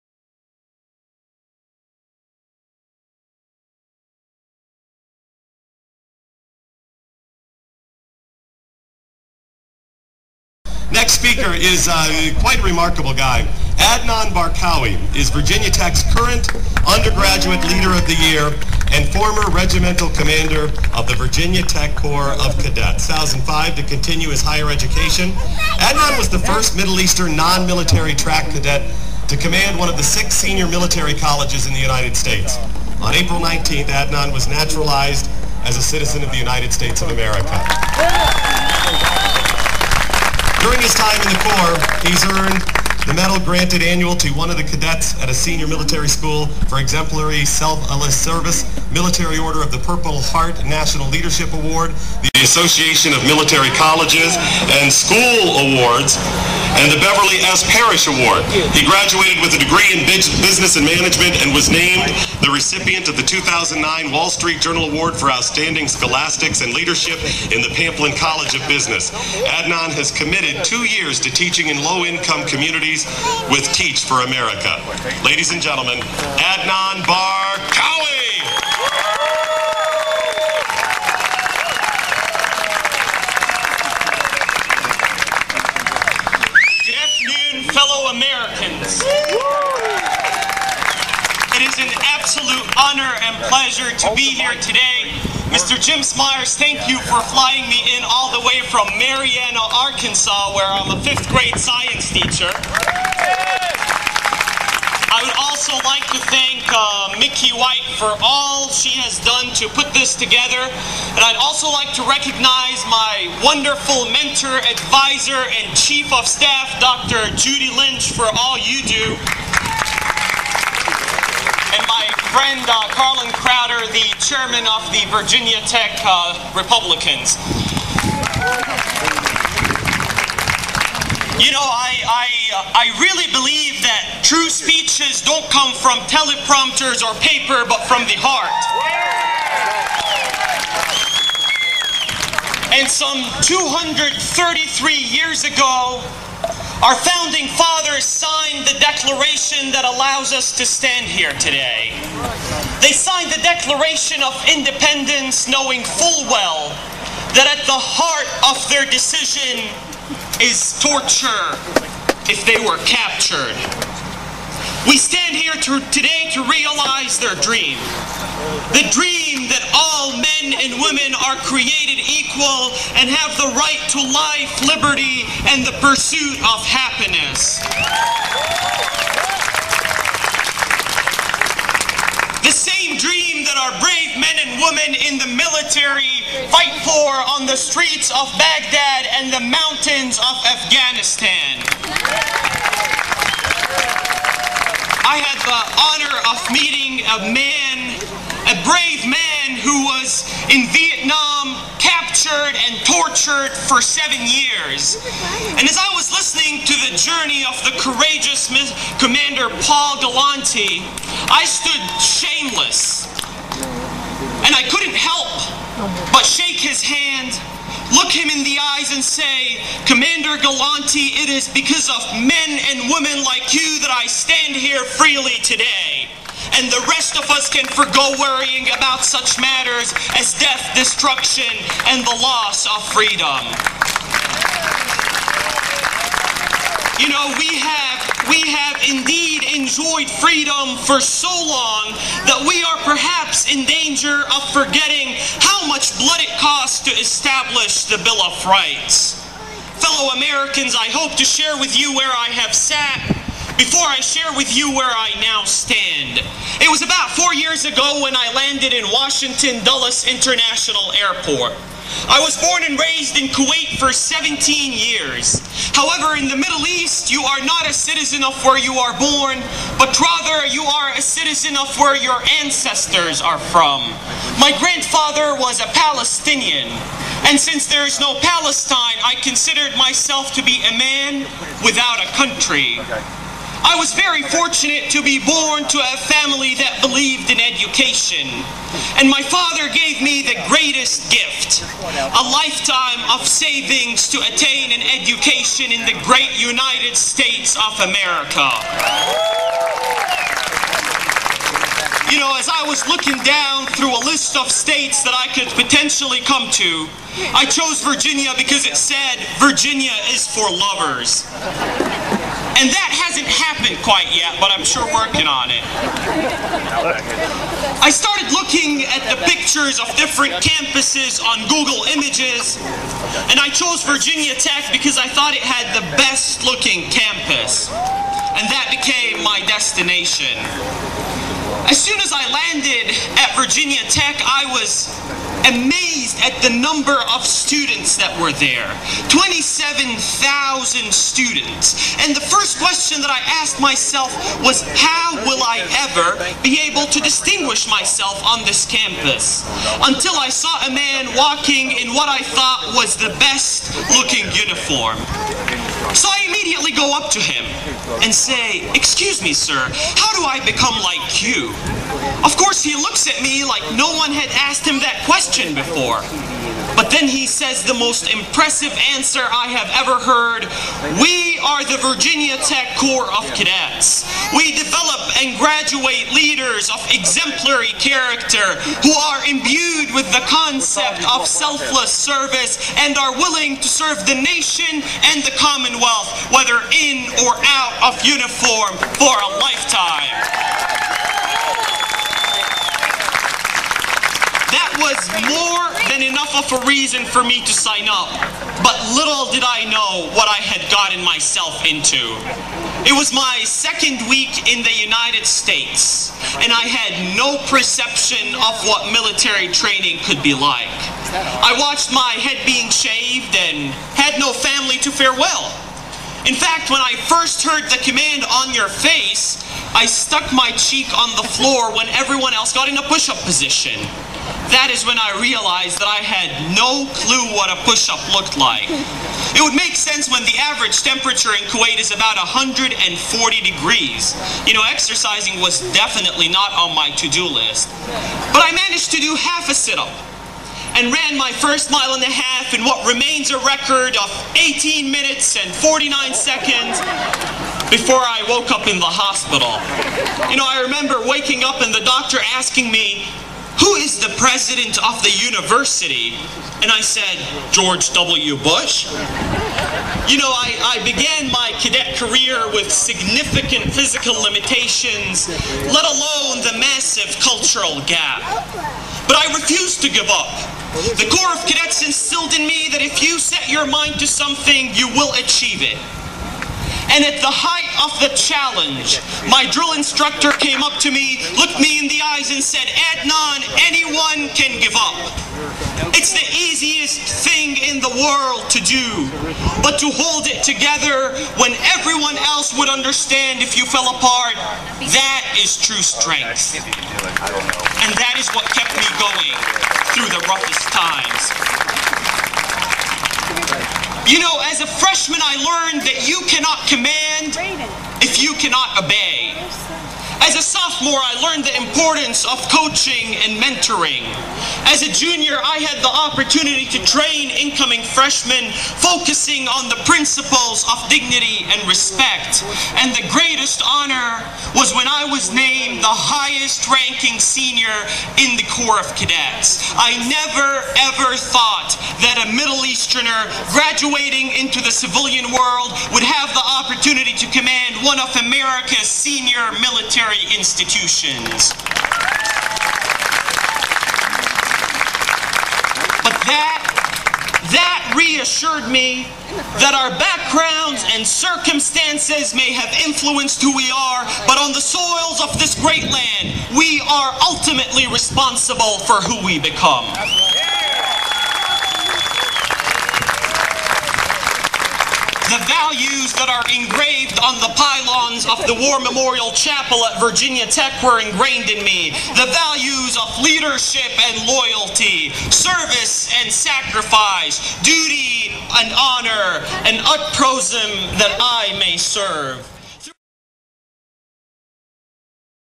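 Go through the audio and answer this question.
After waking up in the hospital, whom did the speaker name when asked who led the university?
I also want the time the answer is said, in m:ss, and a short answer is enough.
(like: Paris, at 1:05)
George W. Bush, at 7:37.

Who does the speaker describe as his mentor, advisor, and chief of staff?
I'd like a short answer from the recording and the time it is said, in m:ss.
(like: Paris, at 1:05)
Dr. Judy Lynch, at 1:56.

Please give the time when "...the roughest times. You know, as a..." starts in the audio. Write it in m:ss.
8:20.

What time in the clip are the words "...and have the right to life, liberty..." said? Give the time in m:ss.
2:52.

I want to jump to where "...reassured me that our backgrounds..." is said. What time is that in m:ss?
9:07.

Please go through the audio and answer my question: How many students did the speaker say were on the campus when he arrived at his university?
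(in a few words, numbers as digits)
27,000.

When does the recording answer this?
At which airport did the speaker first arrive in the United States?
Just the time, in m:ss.
4:18.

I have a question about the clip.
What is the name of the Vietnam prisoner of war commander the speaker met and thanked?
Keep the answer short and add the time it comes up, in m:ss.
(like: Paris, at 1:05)
Paul Galanti, at 3:29.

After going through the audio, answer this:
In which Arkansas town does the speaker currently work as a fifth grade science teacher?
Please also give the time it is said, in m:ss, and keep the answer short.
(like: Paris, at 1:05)
Marianna, at 1:38.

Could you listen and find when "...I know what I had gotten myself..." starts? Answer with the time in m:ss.
6:39.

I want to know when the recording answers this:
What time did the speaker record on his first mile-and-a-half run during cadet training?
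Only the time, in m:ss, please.
7:24.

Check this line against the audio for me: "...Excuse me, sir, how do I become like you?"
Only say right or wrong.
right.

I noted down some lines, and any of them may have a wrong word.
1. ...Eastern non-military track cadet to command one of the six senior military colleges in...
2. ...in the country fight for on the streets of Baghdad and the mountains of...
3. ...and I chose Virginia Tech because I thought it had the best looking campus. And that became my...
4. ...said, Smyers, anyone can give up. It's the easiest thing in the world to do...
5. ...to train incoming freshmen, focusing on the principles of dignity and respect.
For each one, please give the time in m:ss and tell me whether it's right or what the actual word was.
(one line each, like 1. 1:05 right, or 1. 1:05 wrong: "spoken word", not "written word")
1. 0:26 right
2. 3:04 wrong: "military", not "country"
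3. 5:23 right
4. 8:02 wrong: "Adnan", not "Smyers"
5. 8:36 right.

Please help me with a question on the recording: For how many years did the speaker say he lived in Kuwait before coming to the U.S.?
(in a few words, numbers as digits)
17.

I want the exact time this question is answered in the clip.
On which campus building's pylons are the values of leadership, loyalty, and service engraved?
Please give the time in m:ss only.
9:28.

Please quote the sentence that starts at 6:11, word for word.
We are the Virginia Tech Corps of Cadets.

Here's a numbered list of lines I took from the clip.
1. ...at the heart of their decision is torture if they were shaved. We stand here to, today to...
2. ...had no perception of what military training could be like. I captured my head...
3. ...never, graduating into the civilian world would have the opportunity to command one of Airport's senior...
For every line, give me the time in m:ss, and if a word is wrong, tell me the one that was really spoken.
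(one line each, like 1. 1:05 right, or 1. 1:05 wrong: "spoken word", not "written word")
1. 2:37 wrong: "captured", not "shaved"
2. 6:46 wrong: "watched", not "captured"
3. 8:50 wrong: "America", not "Airport".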